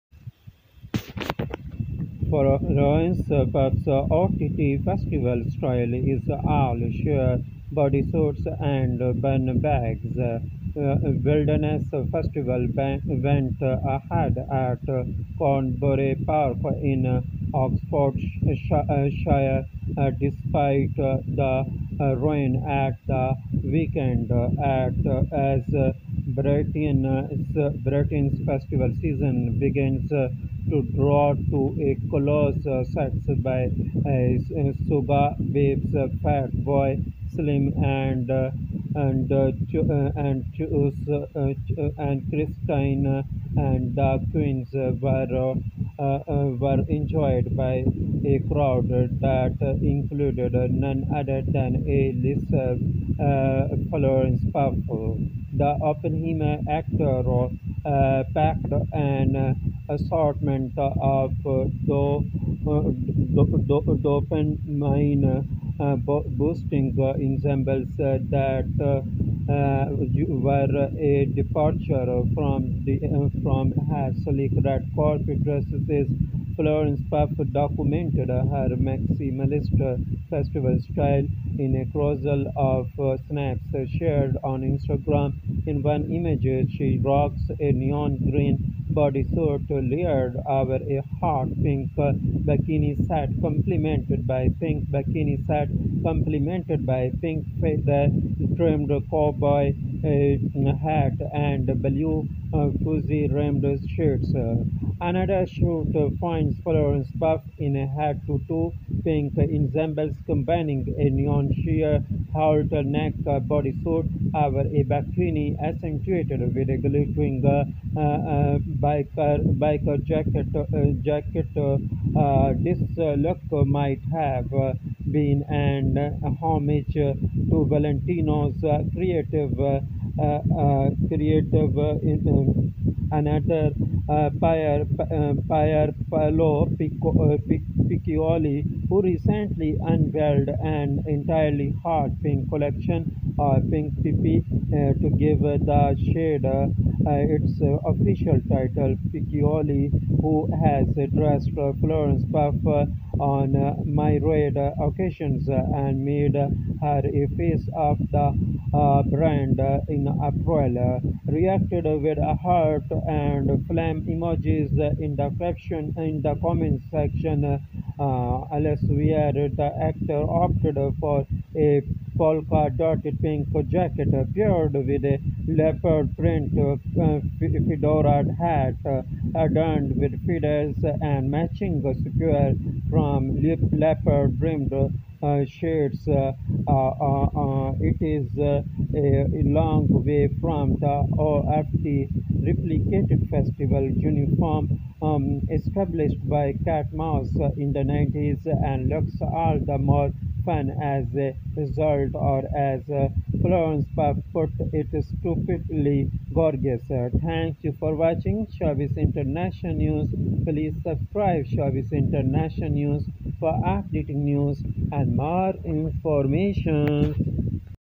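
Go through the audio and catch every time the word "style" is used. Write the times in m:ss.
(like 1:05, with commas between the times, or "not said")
0:05, 1:20.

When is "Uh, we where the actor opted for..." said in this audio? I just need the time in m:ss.
2:47.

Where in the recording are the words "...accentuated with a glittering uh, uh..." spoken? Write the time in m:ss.
1:55.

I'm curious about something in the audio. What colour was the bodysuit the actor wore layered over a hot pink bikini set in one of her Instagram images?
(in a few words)
Neon green.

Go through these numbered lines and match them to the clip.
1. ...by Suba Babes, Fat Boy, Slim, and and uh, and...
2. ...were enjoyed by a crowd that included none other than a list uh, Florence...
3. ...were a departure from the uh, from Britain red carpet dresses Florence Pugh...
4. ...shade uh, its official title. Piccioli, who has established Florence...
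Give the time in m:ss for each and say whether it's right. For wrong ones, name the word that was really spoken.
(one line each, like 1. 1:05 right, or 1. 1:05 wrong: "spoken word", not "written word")
1. 0:33 right
2. 0:46 right
3. 1:10 wrong: "Hasselic", not "Britain"
4. 2:26 wrong: "dressed", not "established".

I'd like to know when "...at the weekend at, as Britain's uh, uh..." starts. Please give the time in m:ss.
0:22.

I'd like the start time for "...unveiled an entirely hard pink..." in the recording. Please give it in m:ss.
2:19.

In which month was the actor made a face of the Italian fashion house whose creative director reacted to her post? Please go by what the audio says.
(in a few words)
April.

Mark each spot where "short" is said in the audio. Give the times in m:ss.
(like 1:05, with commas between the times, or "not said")
1:45.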